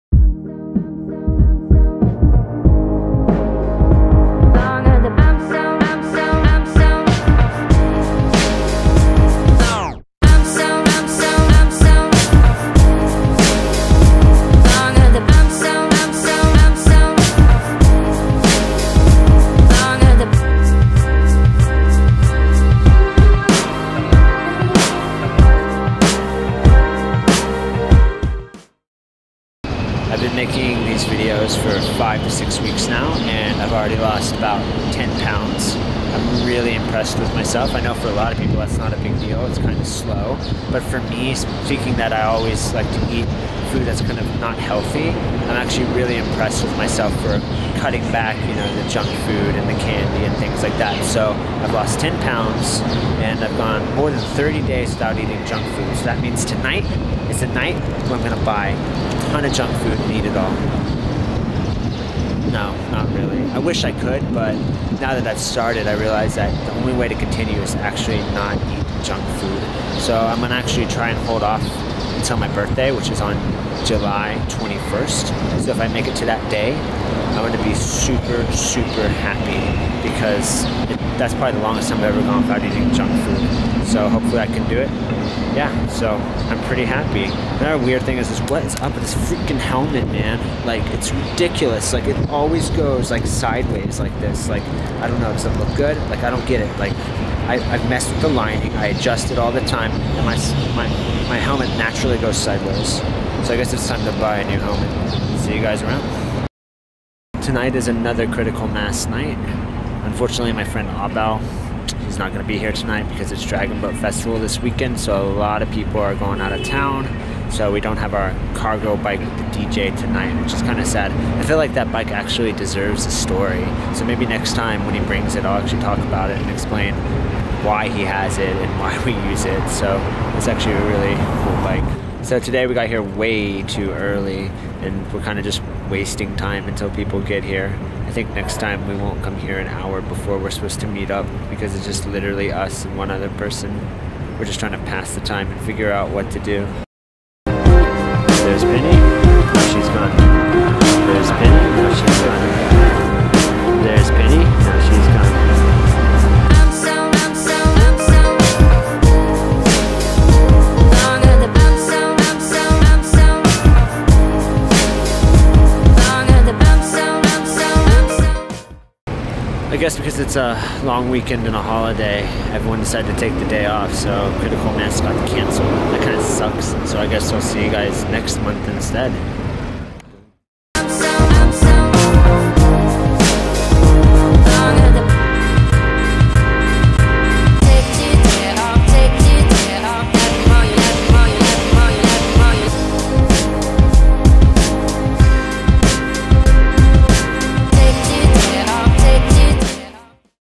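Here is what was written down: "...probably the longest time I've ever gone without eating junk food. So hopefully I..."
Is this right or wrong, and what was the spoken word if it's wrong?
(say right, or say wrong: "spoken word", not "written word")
right.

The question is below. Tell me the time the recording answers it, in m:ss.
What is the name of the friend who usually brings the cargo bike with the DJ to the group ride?
1:50.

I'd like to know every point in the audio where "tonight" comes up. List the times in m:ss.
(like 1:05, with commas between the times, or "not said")
0:56, 1:47, 1:52, 1:59.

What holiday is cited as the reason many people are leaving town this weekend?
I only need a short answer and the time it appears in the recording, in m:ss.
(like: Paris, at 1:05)
Dragon Boat Festival, at 1:53.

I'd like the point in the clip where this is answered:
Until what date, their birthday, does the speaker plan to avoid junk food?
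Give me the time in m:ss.
1:13.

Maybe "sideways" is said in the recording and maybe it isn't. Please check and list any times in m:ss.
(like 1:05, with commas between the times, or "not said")
1:33, 1:42.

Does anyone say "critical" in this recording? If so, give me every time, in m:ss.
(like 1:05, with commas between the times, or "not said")
1:48, 2:54.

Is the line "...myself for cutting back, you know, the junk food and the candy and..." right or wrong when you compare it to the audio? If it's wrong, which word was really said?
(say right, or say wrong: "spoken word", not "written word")
right.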